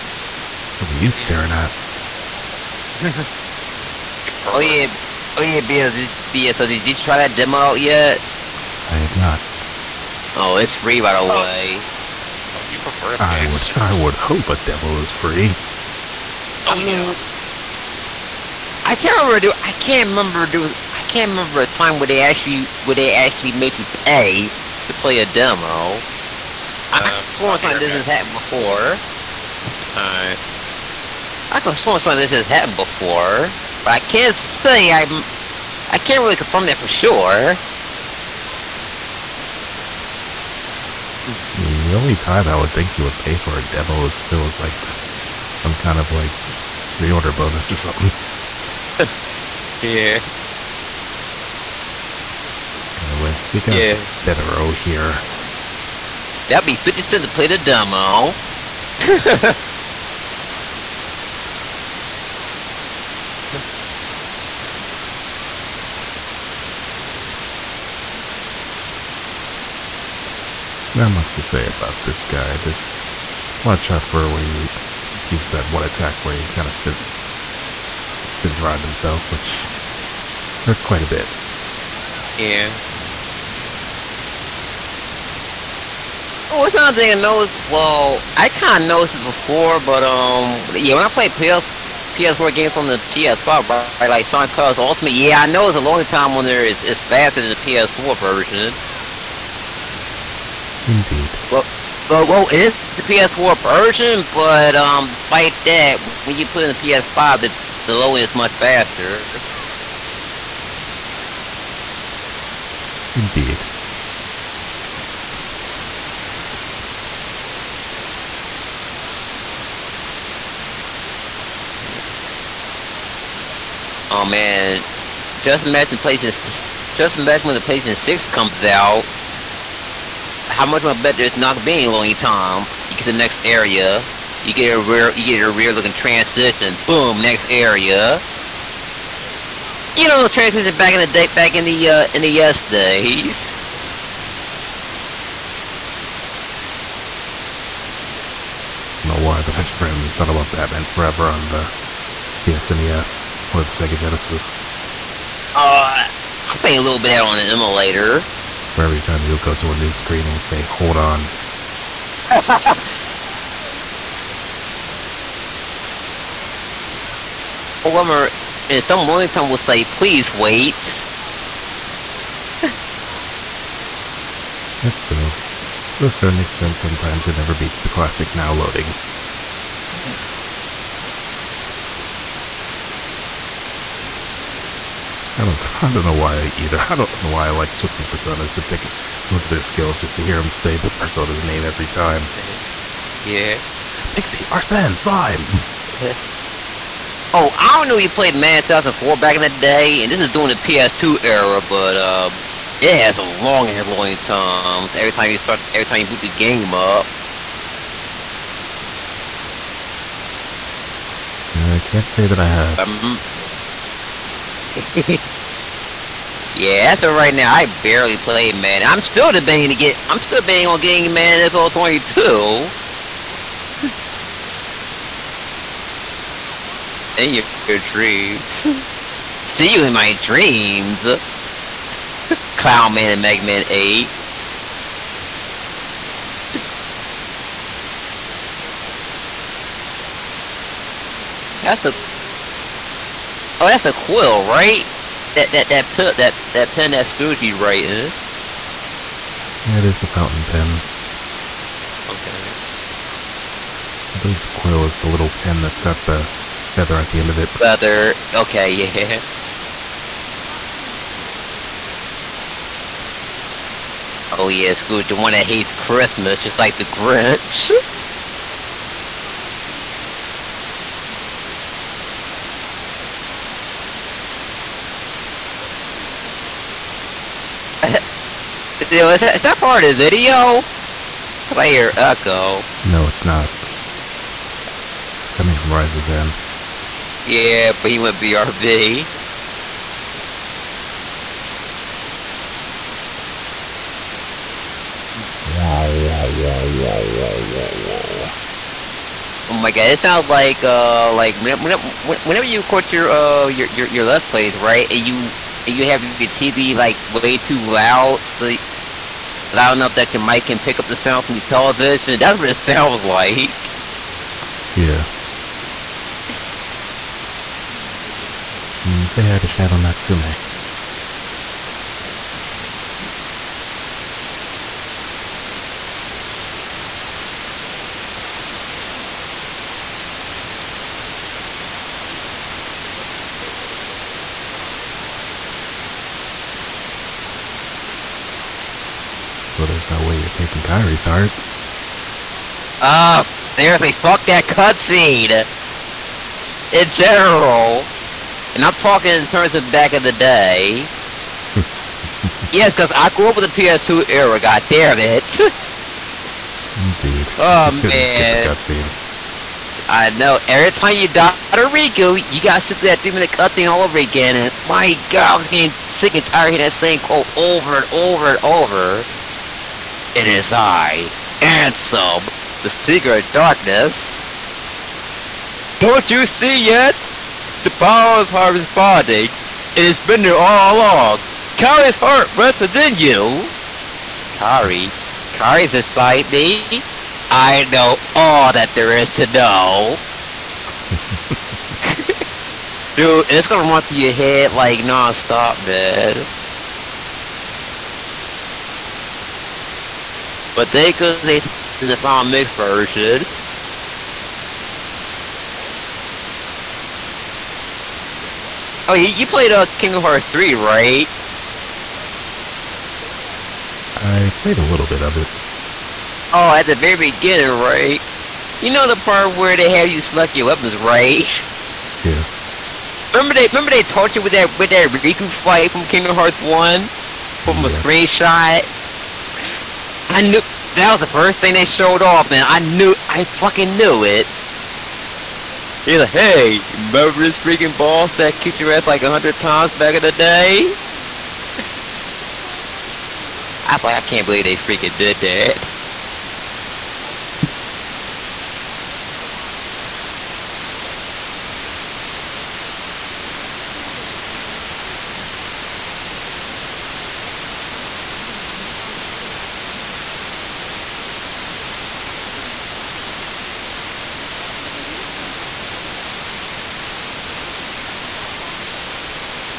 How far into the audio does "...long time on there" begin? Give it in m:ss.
1:35.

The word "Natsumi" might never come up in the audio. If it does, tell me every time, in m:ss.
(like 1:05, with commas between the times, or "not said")
5:19, 7:27.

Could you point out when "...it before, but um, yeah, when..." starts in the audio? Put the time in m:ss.
1:29.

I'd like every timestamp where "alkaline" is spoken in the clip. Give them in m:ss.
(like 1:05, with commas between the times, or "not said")
not said.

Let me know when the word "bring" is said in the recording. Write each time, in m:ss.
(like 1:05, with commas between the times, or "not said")
7:15.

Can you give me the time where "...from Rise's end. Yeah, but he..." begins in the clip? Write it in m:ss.
4:45.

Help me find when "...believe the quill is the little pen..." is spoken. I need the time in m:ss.
4:14.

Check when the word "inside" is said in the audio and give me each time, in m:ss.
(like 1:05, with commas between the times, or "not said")
6:25.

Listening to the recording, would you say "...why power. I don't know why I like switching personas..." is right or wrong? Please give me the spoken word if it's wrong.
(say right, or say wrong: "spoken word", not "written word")
wrong: "either", not "power".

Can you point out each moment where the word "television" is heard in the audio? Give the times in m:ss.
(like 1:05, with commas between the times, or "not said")
5:11.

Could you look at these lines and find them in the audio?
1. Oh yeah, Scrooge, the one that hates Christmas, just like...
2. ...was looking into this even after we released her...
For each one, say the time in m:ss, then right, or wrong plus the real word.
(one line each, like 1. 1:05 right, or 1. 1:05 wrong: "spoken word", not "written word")
1. 4:24 right
2. 7:33 wrong: "changed", not "released".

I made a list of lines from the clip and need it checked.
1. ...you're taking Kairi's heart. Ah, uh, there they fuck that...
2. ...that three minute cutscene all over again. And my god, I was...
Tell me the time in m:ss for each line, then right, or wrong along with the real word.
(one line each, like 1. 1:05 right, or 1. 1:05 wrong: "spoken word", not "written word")
1. 5:40 right
2. 6:02 right.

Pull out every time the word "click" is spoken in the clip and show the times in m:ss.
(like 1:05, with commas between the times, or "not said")
not said.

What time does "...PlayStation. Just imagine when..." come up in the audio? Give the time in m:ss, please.
2:05.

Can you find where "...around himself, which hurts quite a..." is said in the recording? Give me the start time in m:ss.
1:18.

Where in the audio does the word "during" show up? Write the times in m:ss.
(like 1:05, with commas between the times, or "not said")
3:20.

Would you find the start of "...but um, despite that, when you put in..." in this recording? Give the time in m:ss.
1:44.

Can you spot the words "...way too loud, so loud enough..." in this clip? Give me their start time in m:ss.
5:07.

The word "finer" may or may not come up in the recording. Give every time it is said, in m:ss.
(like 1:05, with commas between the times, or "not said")
not said.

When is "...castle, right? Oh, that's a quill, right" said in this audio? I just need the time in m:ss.
4:02.